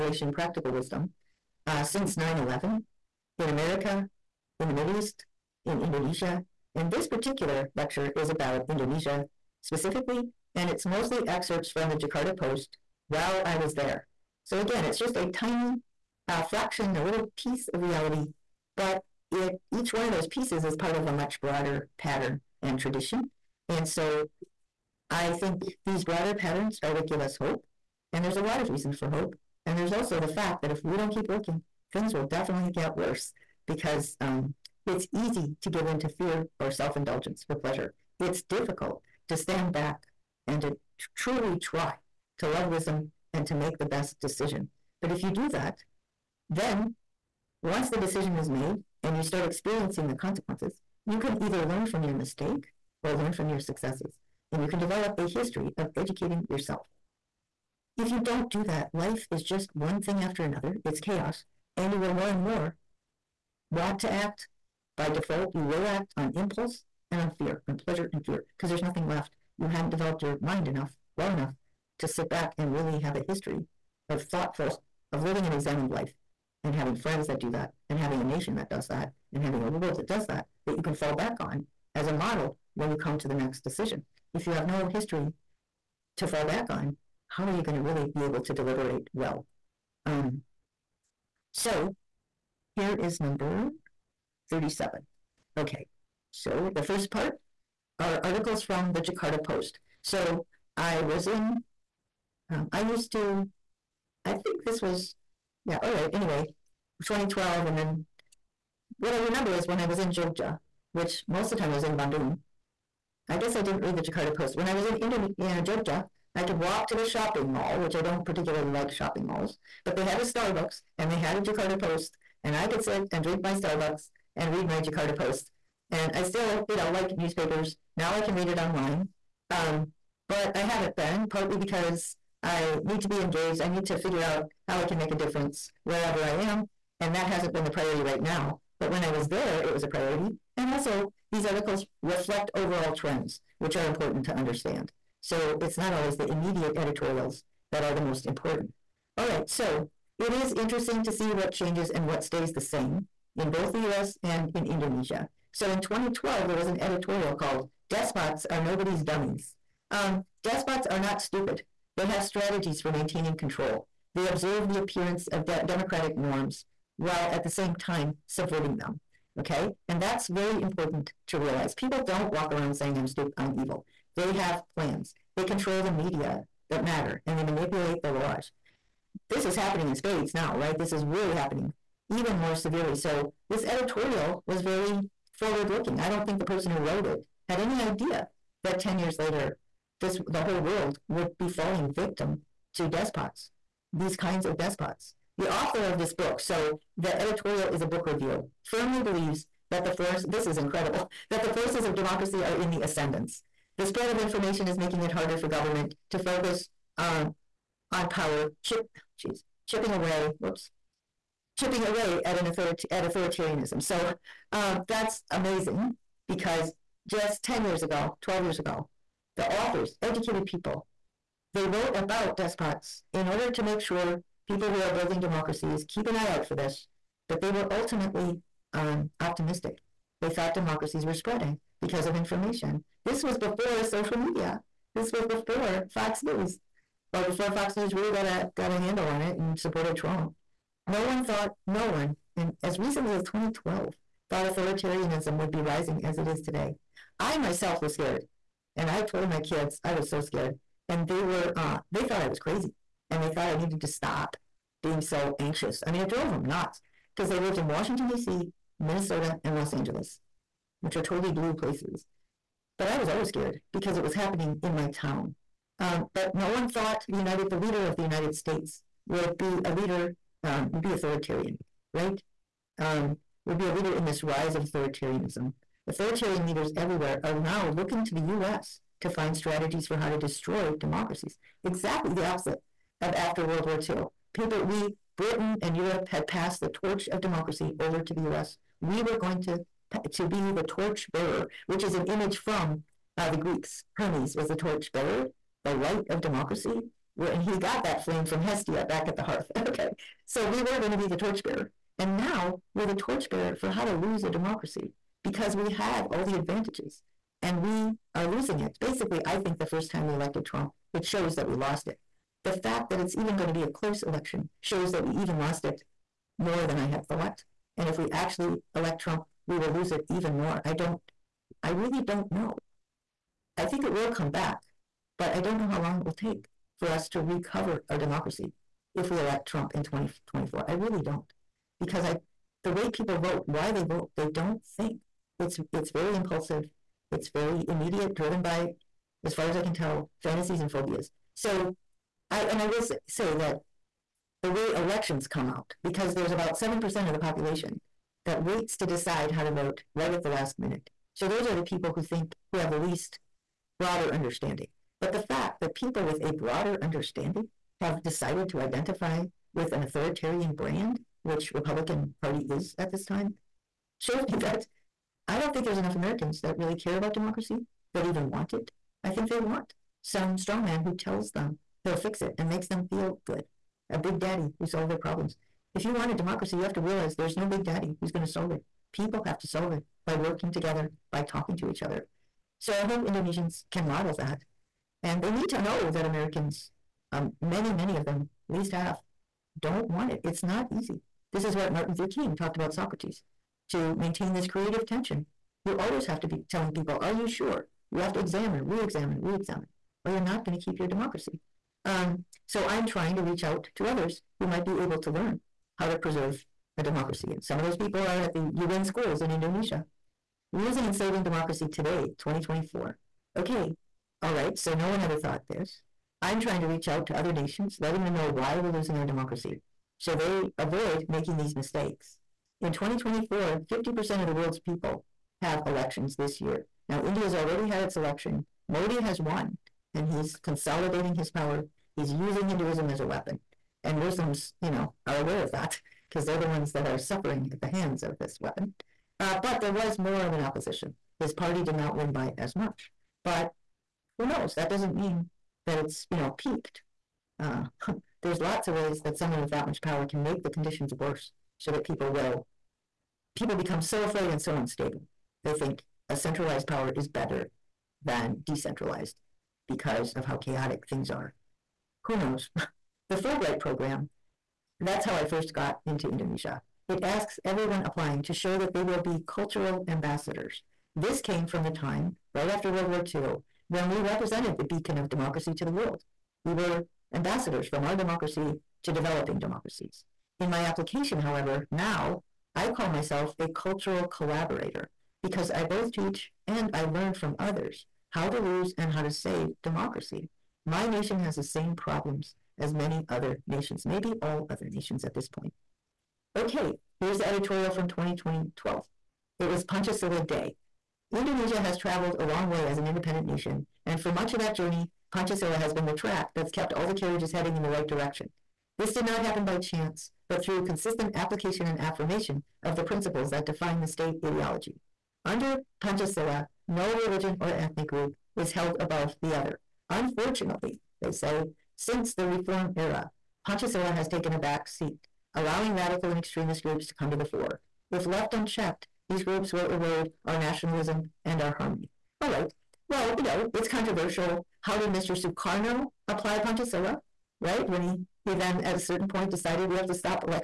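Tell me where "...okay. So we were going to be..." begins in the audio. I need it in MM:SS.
04:59.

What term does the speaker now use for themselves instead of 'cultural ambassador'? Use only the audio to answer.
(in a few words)
cultural collaborator.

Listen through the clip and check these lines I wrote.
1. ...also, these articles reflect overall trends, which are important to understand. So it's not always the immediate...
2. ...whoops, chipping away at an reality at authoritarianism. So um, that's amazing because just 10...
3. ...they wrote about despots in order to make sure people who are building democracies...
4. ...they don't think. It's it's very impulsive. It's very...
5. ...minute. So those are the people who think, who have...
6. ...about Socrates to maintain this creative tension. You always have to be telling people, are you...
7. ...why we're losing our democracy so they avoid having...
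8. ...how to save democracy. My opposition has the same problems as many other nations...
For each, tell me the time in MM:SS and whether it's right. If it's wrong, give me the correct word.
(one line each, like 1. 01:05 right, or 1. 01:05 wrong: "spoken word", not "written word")
1. 02:20 right
2. 03:30 wrong: "authority", not "reality"
3. 03:41 right
4. 05:34 right
5. 05:50 right
6. 06:32 right
7. 06:58 wrong: "making", not "having"
8. 08:08 wrong: "nation", not "opposition".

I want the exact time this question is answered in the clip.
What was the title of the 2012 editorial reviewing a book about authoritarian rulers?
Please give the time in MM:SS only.
02:37.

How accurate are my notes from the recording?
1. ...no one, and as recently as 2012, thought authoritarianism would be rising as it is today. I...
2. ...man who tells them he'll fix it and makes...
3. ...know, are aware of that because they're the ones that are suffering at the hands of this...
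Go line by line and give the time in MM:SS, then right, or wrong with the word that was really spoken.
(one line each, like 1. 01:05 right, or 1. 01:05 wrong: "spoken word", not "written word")
1. 04:01 right
2. 06:10 right
3. 07:14 right.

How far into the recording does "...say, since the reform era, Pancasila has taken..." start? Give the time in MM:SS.
08:41.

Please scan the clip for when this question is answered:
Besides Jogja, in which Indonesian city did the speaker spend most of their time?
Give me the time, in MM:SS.
01:51.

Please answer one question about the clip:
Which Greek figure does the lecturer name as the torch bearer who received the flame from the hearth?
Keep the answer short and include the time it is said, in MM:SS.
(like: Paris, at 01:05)
Hermes, at 04:53.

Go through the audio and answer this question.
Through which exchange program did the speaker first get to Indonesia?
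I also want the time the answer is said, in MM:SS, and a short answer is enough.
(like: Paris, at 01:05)
Fulbright, at 07:43.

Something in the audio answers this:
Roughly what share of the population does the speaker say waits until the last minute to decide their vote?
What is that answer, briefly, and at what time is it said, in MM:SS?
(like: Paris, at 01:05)
7%, at 05:46.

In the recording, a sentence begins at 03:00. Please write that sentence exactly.
This is really happening even more severely.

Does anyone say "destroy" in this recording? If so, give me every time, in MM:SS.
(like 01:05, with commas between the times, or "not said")
04:40.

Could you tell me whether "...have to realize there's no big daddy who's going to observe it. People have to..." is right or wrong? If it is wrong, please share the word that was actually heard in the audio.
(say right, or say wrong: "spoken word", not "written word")
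wrong: "solve", not "observe".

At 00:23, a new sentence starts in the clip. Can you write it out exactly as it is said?
And so I think these broader patterns are what give us hope.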